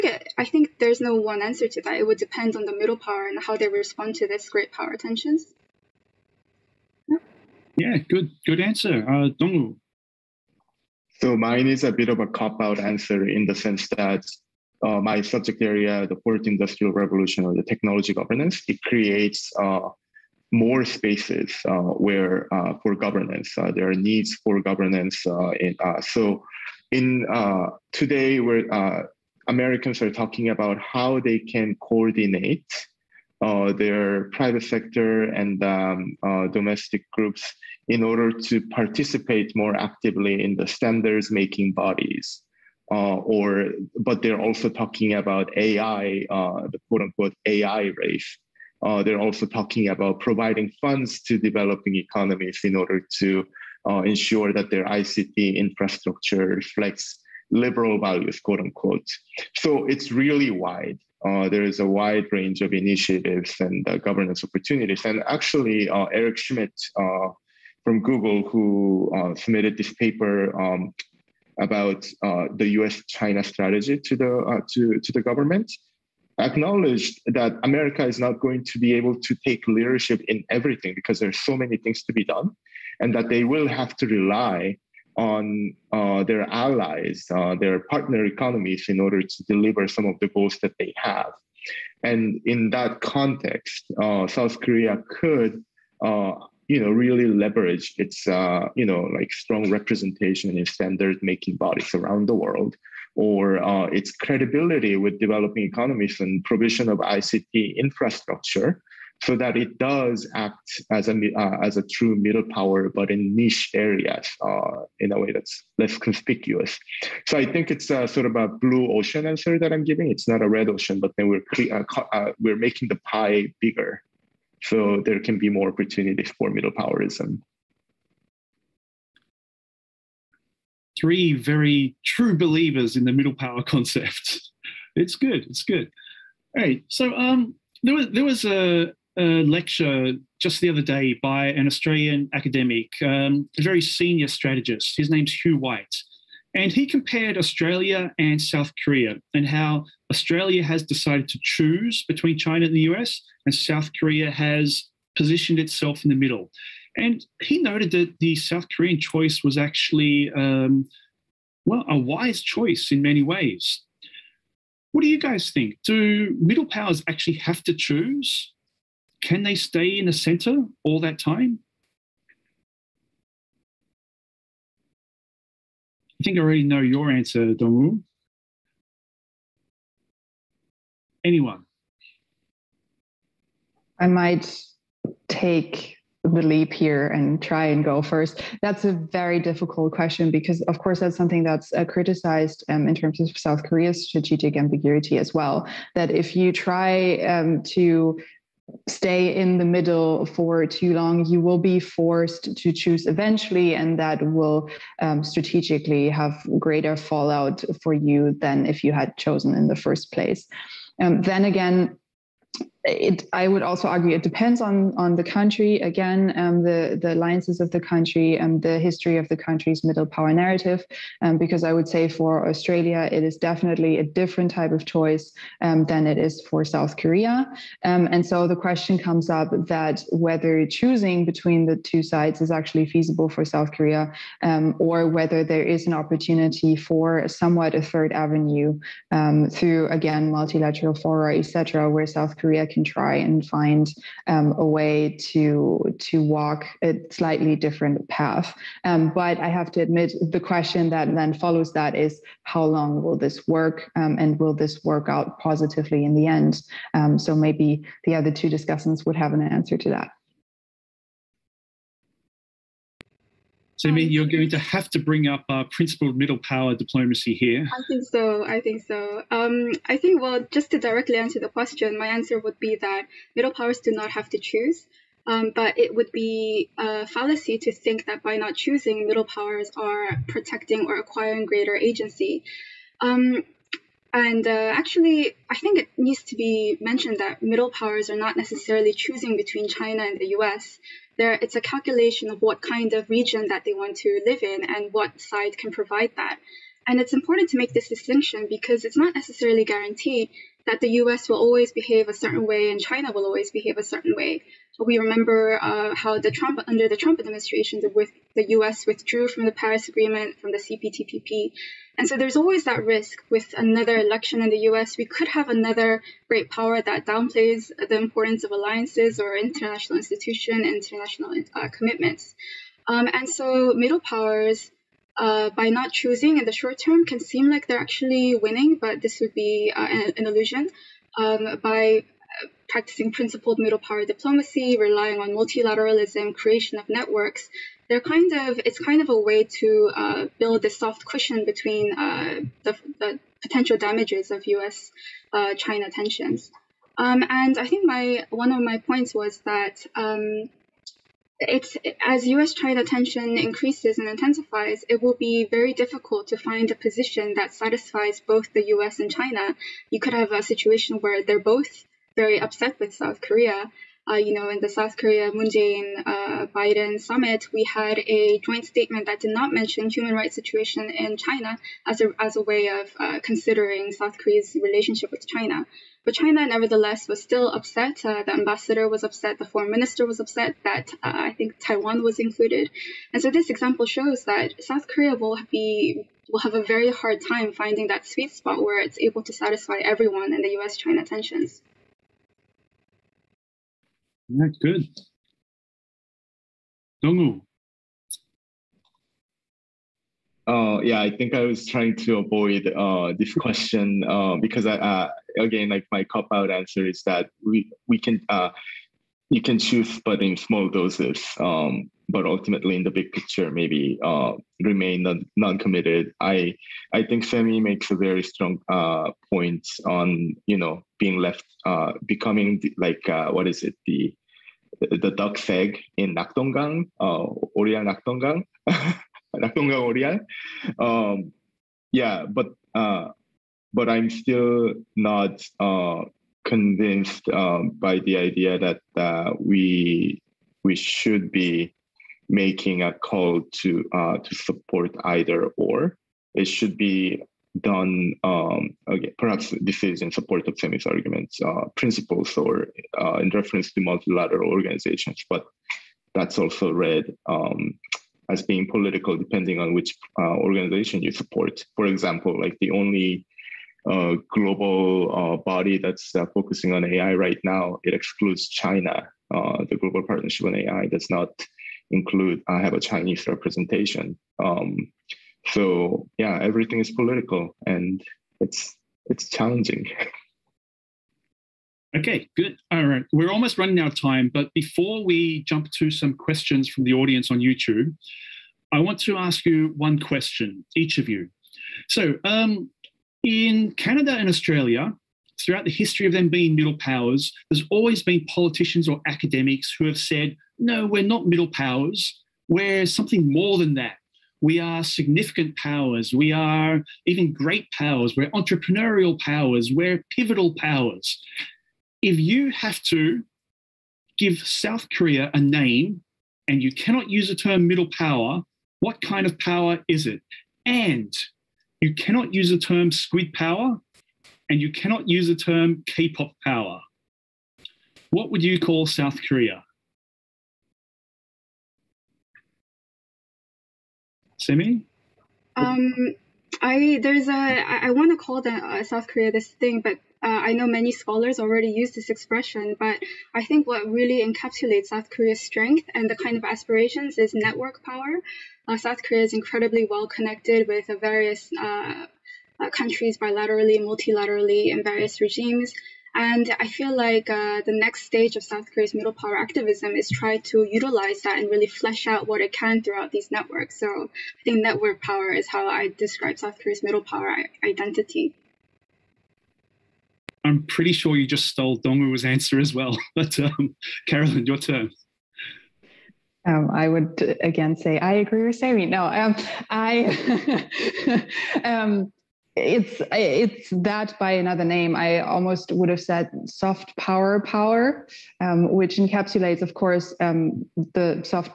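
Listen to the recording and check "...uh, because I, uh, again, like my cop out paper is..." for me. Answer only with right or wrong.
wrong.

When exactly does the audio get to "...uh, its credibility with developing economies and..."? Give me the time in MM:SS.
01:43.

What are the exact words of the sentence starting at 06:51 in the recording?
Um, but ultimately, in the big picture, maybe uh, remain non committed.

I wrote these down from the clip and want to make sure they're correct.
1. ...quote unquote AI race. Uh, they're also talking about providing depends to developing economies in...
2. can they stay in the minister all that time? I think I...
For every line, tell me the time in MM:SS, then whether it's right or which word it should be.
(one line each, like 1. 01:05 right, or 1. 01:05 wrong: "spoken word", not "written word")
1. 00:46 wrong: "funds", not "depends"
2. 02:49 wrong: "center", not "minister".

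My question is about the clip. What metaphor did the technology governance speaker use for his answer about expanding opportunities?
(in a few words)
blue ocean.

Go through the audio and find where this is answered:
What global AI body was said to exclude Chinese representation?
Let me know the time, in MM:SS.
07:49.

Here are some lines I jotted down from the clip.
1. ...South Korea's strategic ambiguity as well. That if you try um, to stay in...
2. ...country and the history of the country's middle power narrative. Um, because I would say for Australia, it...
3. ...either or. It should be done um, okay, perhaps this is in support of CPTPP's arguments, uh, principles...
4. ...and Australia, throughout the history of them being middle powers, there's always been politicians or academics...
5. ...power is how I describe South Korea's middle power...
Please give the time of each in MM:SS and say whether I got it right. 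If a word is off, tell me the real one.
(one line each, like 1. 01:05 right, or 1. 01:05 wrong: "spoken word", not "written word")
1. 03:13 right
2. 03:37 right
3. 07:25 wrong: "Saeme", not "CPTPP"
4. 08:14 right
5. 09:25 right.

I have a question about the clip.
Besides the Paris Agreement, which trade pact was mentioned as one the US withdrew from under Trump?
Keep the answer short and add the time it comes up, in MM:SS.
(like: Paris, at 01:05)
CPTPP, at 05:10.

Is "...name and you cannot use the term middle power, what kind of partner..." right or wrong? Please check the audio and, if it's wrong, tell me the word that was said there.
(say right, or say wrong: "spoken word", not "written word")
wrong: "power", not "partner".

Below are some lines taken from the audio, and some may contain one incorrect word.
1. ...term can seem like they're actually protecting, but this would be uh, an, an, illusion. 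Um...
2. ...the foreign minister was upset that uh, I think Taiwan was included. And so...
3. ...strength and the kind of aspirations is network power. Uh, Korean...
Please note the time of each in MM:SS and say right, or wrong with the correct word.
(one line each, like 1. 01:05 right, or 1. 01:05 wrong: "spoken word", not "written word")
1. 05:26 wrong: "winning", not "protecting"
2. 06:19 right
3. 09:05 wrong: "South", not "Korean".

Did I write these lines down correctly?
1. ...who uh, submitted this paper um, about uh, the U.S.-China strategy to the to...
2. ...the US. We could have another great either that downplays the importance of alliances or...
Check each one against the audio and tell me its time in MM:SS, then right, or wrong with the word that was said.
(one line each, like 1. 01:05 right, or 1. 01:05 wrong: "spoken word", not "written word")
1. 01:08 right
2. 05:14 wrong: "power", not "either".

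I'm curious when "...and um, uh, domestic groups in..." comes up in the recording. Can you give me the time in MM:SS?
00:35.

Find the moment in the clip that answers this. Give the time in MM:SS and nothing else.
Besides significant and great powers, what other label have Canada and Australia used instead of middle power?
08:30.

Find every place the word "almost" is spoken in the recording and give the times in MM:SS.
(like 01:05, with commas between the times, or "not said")
08:03, 09:45.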